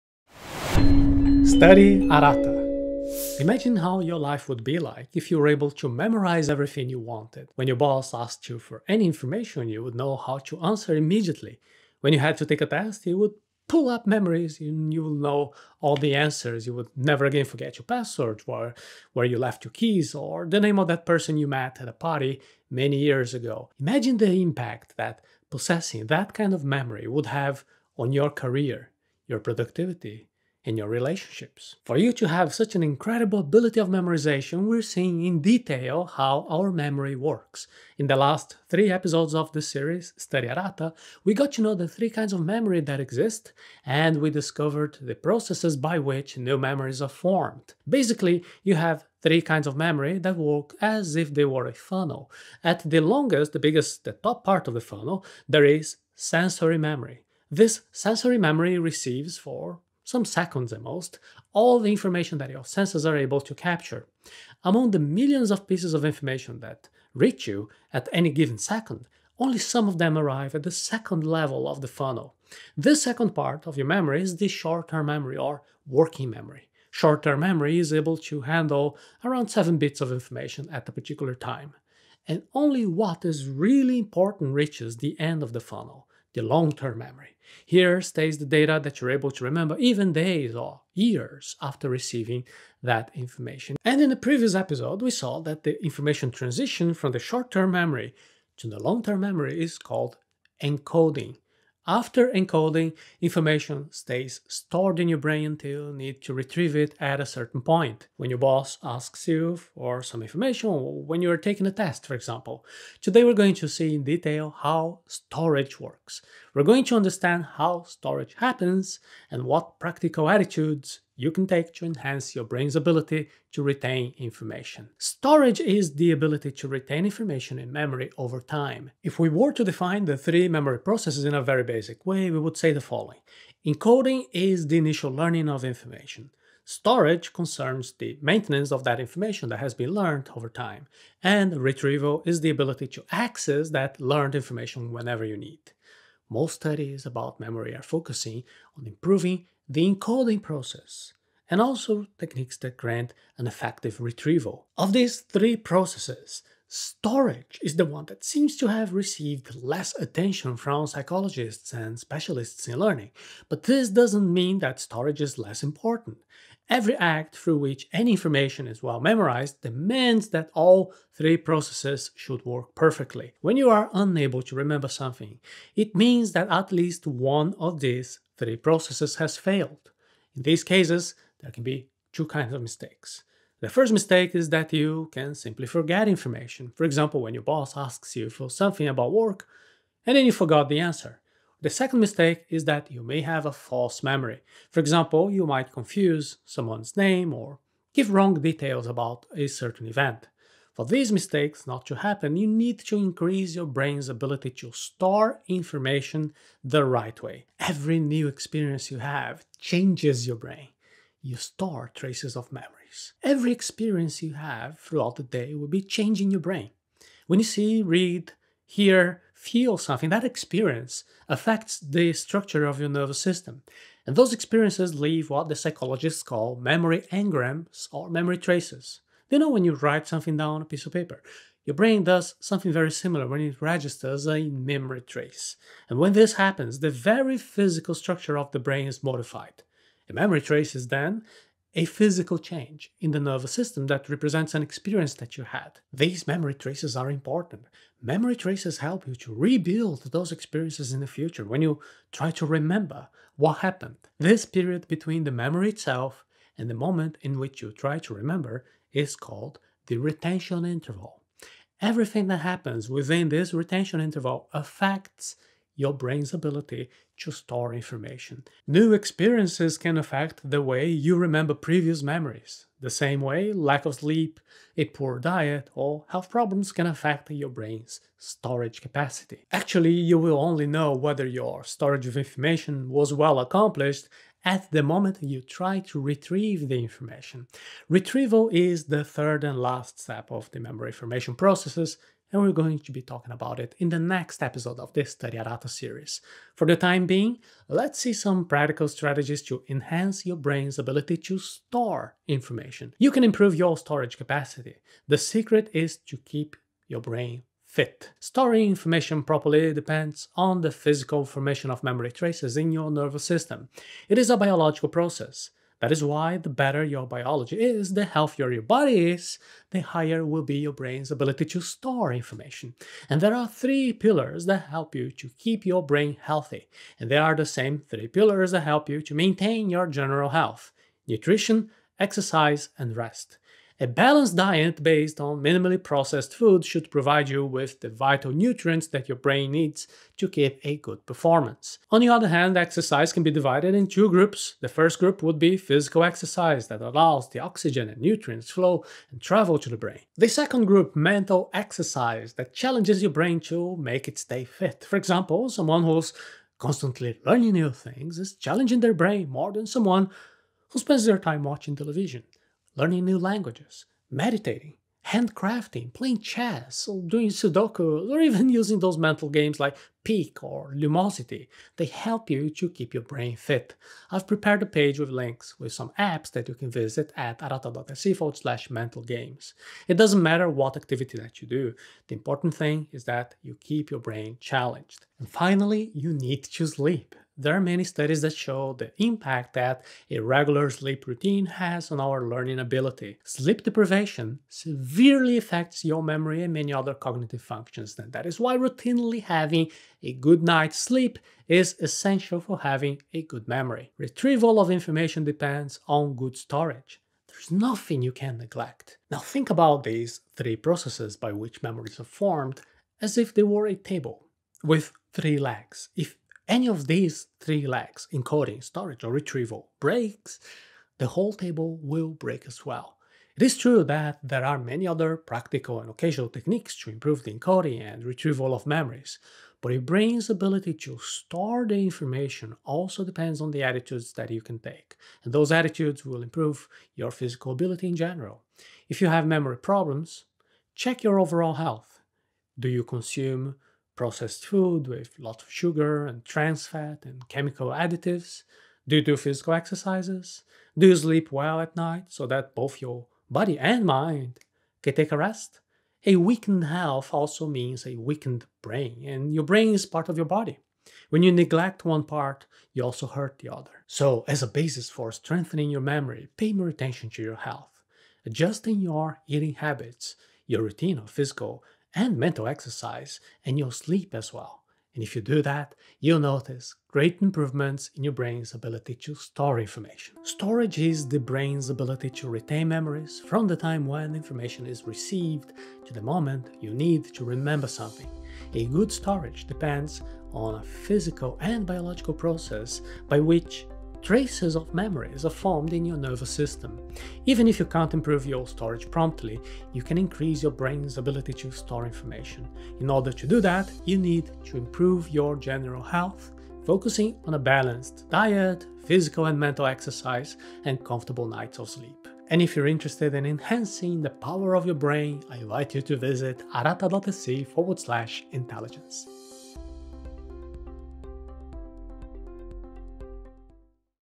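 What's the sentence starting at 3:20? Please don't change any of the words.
For these mistakes not to happen, you need to increase your brain's ability to store information the right way.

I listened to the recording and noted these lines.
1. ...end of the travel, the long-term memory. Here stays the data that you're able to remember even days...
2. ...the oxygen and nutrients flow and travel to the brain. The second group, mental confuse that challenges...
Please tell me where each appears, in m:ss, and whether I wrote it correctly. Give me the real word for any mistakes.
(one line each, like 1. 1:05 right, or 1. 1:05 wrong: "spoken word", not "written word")
1. 1:25 wrong: "funnel", not "travel"
2. 5:47 wrong: "exercise", not "confuse".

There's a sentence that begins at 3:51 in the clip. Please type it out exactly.
Your brain does something very similar when it registers a memory trace.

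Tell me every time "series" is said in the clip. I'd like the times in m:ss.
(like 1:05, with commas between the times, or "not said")
0:39, 4:55.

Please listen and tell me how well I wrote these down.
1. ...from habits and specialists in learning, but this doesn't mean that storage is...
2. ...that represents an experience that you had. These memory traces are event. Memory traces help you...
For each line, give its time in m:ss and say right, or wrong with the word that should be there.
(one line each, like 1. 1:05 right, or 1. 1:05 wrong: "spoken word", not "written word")
1. 2:40 wrong: "psychologists", not "habits"
2. 4:03 wrong: "important", not "event".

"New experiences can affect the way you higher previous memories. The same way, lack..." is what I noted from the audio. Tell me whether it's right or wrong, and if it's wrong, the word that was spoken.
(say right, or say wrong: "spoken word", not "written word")
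wrong: "remember", not "higher".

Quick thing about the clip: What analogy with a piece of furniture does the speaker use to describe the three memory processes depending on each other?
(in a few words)
a table with three legs.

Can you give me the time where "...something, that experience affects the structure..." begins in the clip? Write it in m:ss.
3:39.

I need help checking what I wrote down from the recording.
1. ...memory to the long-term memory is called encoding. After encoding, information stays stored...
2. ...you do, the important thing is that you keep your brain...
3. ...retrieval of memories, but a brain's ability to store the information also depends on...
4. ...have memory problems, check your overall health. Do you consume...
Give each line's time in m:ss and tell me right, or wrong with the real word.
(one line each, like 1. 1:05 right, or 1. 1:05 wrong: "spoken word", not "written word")
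1. 1:37 right
2. 6:21 right
3. 7:08 right
4. 7:19 right.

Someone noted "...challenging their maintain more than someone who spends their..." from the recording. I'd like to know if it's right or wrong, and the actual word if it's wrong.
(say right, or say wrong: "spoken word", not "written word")
wrong: "brain", not "maintain".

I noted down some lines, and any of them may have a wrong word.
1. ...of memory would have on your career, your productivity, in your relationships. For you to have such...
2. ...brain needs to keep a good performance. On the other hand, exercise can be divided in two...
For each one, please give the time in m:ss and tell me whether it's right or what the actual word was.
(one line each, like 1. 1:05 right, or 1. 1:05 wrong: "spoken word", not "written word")
1. 0:26 right
2. 5:39 right.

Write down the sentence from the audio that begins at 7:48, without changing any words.
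Adjusting your eating habits, your routine of physical and mental exercise, and your sleep as well.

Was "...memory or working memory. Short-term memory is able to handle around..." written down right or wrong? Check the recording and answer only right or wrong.
right.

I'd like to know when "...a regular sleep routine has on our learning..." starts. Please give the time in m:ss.
6:30.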